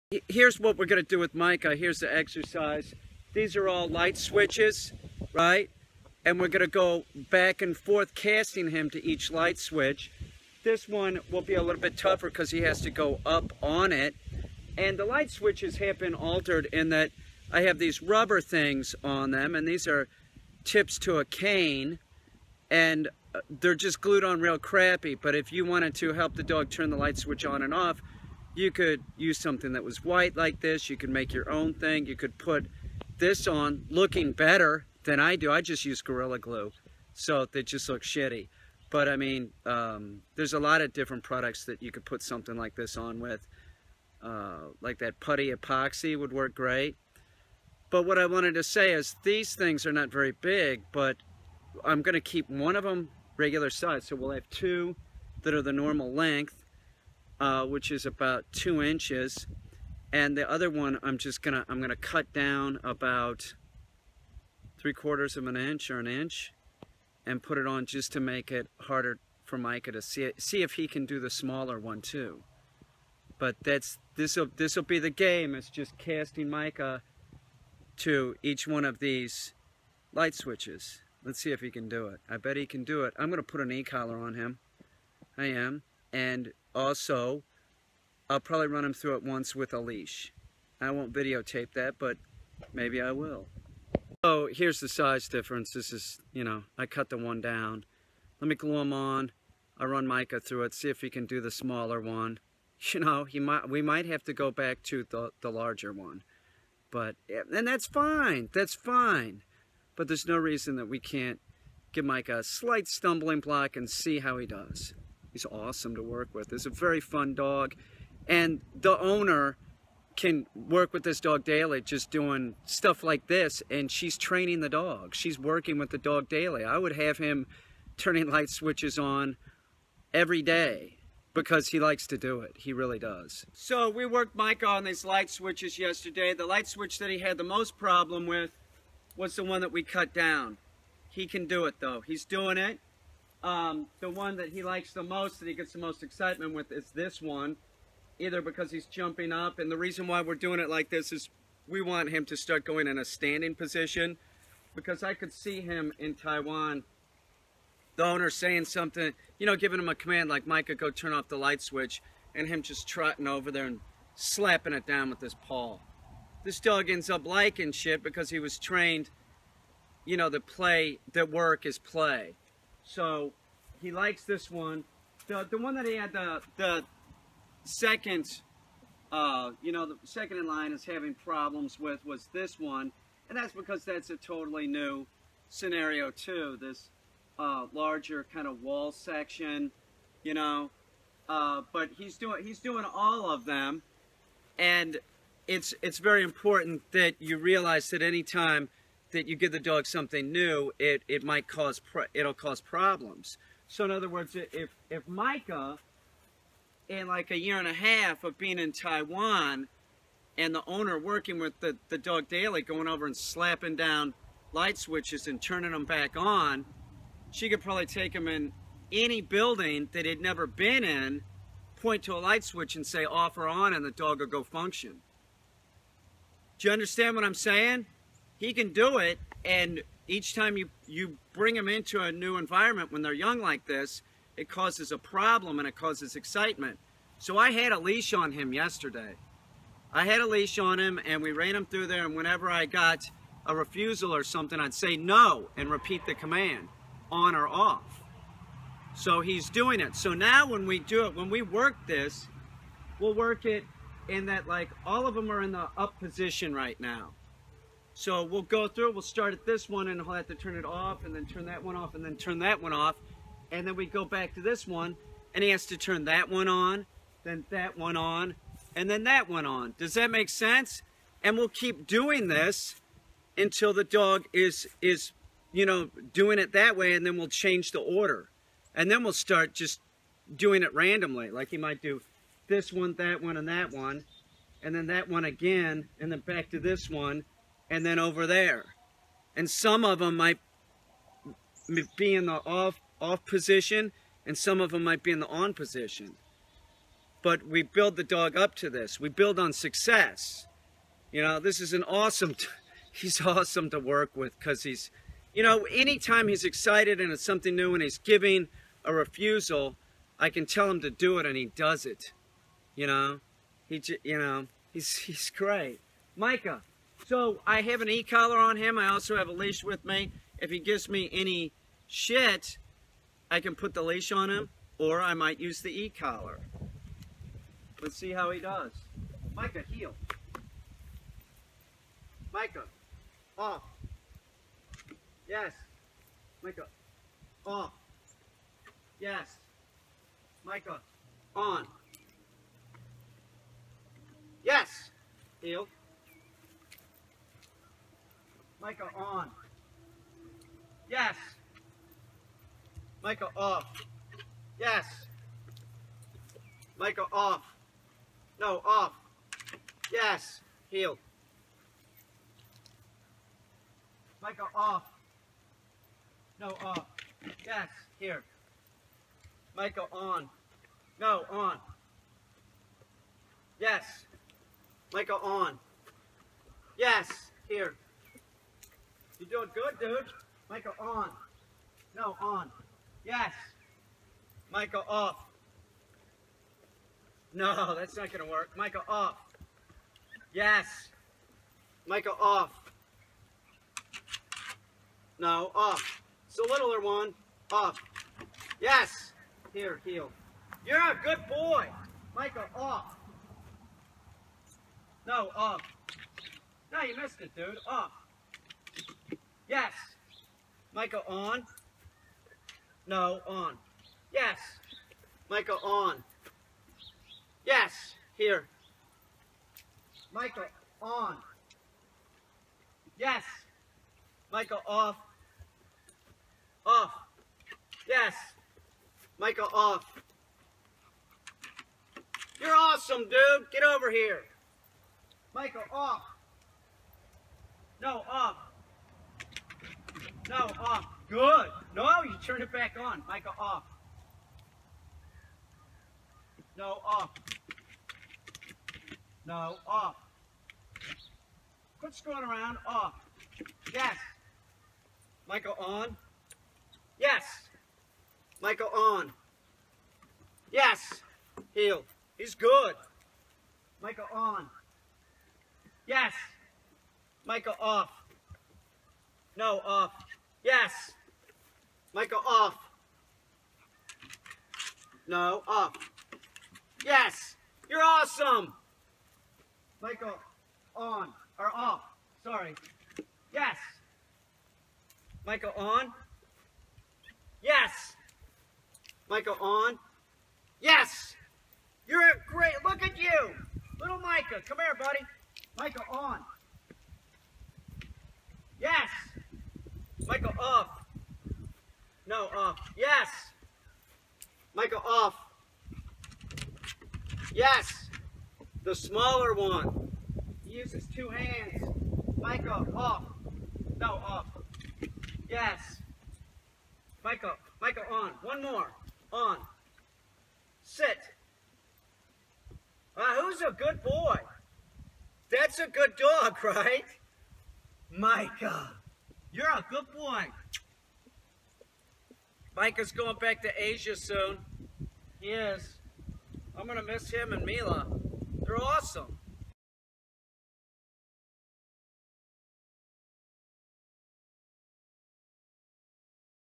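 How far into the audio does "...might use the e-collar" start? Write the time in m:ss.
5:25.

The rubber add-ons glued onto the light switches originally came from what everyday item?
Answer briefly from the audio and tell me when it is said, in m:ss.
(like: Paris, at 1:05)
a cane, at 0:20.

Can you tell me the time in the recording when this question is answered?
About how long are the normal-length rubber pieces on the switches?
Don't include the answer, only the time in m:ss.
0:58.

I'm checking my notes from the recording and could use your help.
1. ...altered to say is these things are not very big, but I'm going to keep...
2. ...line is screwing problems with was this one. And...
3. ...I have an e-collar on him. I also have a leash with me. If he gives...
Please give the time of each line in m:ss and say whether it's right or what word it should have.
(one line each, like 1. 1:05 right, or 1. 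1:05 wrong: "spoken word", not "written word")
1. 0:48 wrong: "wanted", not "altered"
2. 3:00 wrong: "having", not "screwing"
3. 5:17 right.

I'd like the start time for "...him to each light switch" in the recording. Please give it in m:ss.
0:08.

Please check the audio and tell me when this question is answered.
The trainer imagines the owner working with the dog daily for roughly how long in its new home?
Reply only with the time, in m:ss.
3:27.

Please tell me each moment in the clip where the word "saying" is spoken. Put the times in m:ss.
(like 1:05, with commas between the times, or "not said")
2:38, 3:47.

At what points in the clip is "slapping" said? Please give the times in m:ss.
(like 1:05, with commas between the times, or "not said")
2:44, 3:33.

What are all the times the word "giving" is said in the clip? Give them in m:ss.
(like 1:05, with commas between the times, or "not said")
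2:39, 5:07.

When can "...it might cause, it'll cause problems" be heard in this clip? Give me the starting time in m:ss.
3:21.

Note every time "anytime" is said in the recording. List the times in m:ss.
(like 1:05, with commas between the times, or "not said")
3:18, 5:05.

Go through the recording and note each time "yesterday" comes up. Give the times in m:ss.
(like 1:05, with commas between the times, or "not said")
2:15, 3:58.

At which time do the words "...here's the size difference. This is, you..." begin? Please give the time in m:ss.
1:34.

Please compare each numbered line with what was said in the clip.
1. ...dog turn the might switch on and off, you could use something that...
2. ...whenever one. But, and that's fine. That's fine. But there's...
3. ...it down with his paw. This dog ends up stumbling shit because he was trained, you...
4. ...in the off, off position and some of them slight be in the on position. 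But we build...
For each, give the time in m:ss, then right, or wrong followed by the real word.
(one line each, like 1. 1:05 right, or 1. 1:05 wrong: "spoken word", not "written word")
1. 0:26 wrong: "light", not "might"
2. 1:45 wrong: "larger", not "whenever"
3. 2:44 wrong: "liking", not "stumbling"
4. 4:52 wrong: "might", not "slight".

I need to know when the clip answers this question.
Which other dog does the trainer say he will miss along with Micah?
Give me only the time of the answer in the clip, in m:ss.
8:57.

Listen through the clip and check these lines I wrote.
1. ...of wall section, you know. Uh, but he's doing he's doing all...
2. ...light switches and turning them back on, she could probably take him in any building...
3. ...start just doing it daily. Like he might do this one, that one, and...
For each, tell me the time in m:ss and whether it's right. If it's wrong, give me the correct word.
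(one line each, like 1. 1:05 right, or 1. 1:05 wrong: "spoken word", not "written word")
1. 3:08 right
2. 3:34 right
3. 4:39 wrong: "randomly", not "daily".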